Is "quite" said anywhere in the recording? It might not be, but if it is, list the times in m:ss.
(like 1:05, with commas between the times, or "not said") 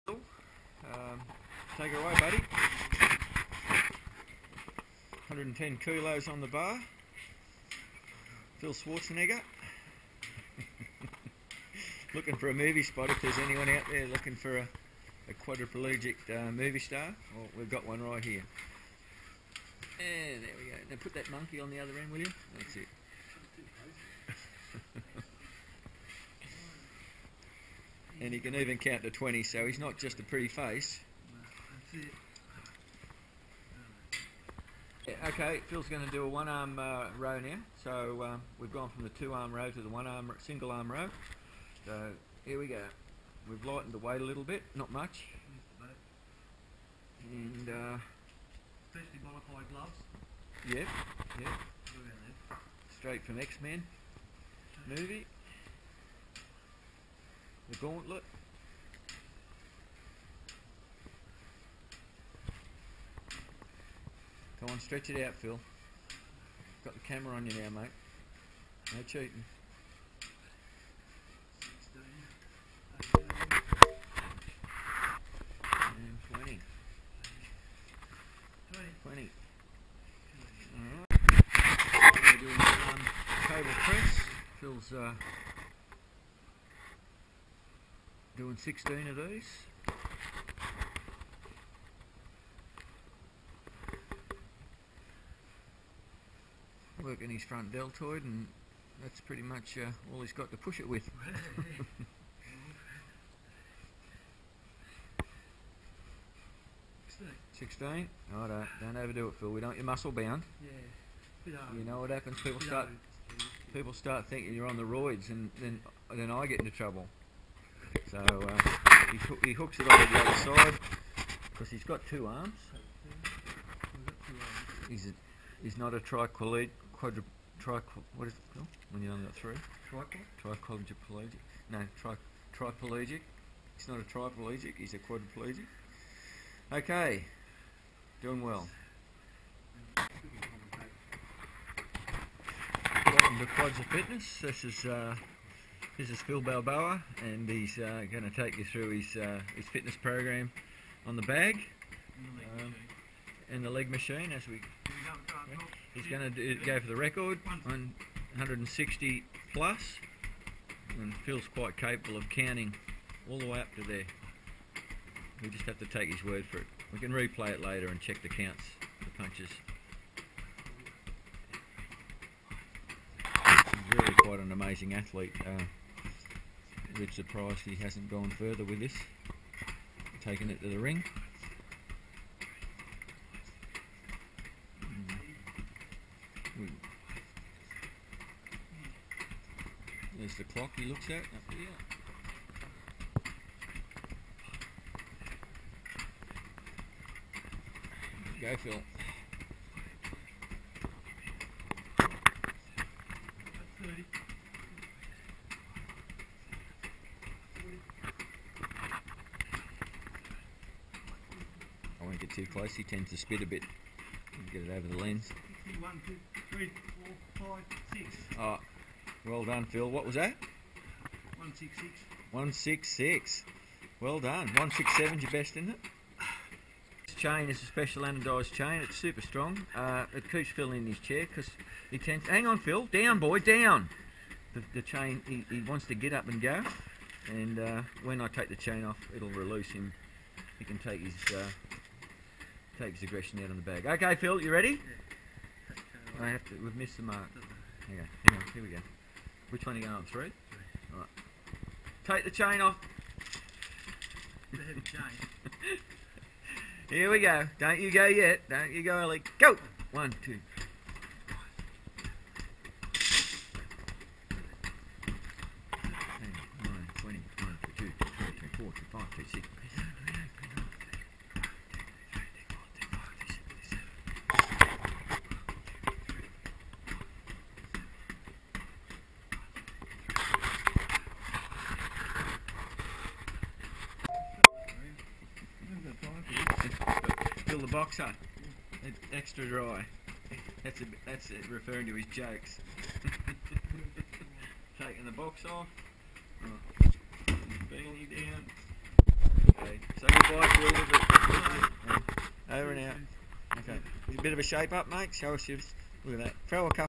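2:41, 2:54.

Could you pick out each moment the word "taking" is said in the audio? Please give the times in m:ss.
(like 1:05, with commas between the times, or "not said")
3:00, 4:54.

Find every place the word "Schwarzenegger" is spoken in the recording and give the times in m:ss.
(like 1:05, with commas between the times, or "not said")
0:08.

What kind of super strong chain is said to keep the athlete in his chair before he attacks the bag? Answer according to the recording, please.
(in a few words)
anodised chain.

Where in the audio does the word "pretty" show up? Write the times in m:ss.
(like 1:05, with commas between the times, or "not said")
0:30, 1:39.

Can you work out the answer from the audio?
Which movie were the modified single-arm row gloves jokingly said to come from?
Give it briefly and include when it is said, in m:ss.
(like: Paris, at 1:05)
X-Men, at 0:53.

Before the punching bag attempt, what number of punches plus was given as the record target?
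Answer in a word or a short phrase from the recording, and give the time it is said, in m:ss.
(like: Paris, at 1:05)
160, at 2:38.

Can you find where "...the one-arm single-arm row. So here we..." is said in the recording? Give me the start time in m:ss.
0:39.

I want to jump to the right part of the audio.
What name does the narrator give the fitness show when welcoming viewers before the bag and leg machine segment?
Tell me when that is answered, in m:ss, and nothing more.
2:23.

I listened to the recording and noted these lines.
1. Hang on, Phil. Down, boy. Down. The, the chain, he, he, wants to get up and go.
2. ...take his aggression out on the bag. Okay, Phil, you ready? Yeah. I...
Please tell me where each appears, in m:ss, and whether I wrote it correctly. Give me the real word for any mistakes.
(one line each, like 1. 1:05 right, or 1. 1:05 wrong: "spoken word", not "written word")
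1. 3:52 right
2. 4:02 right.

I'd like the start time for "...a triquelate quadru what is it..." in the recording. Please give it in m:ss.
2:05.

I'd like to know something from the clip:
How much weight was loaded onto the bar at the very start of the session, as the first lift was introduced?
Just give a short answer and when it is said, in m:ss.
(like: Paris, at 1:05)
110 kilos, at 0:05.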